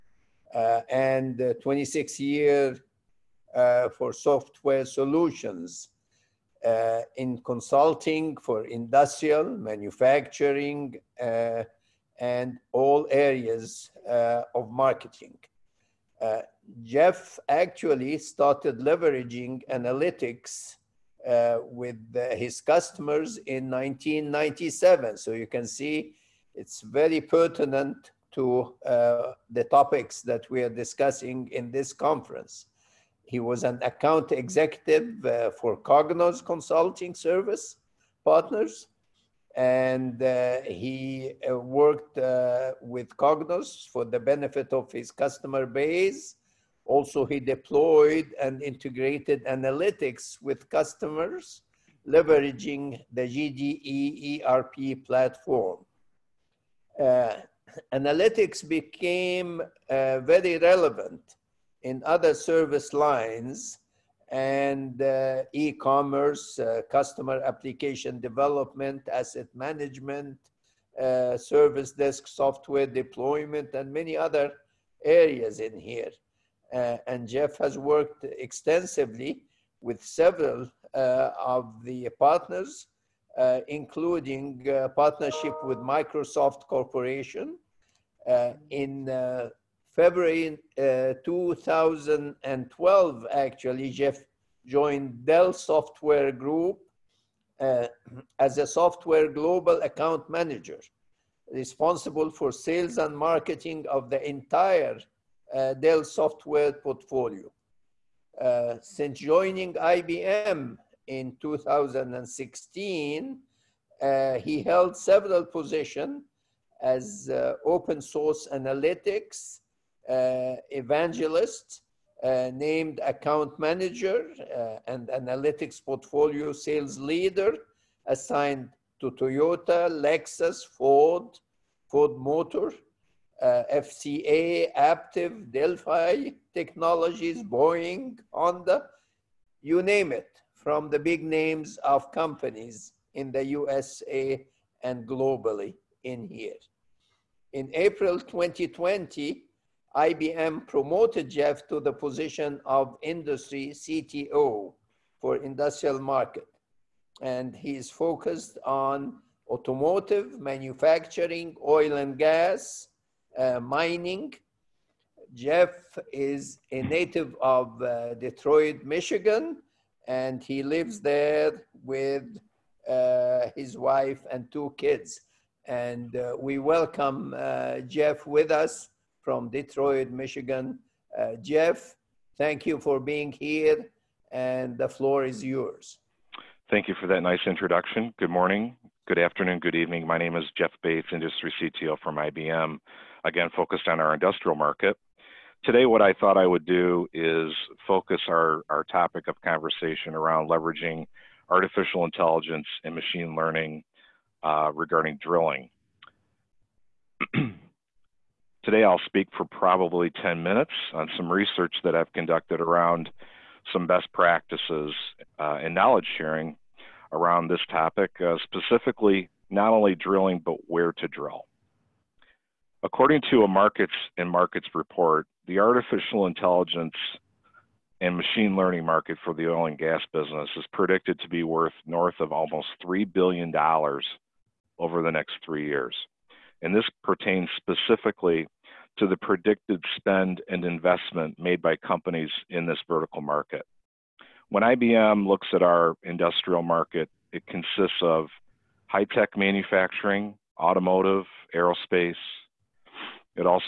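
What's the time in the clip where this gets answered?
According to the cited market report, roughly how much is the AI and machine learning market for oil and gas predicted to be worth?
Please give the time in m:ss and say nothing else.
3:52.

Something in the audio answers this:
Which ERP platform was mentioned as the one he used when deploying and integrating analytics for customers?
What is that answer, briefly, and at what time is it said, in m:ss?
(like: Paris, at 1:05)
JDE, at 0:53.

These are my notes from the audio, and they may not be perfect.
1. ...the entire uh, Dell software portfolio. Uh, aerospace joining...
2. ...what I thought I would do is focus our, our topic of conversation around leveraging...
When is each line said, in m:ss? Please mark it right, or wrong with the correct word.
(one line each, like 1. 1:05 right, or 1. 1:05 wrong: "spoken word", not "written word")
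1. 1:44 wrong: "since", not "aerospace"
2. 3:15 right.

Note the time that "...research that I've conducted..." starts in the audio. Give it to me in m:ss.
3:31.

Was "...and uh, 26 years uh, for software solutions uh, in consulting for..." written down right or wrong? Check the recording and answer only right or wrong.
right.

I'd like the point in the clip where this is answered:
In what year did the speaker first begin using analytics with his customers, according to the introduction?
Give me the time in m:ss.
0:23.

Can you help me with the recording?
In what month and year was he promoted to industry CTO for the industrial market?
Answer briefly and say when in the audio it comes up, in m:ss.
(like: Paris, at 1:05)
April 2020, at 2:27.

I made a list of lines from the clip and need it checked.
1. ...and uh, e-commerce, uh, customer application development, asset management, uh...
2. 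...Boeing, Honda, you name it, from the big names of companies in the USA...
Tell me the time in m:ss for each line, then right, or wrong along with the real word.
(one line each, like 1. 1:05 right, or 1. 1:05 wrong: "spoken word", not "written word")
1. 1:04 right
2. 2:17 right.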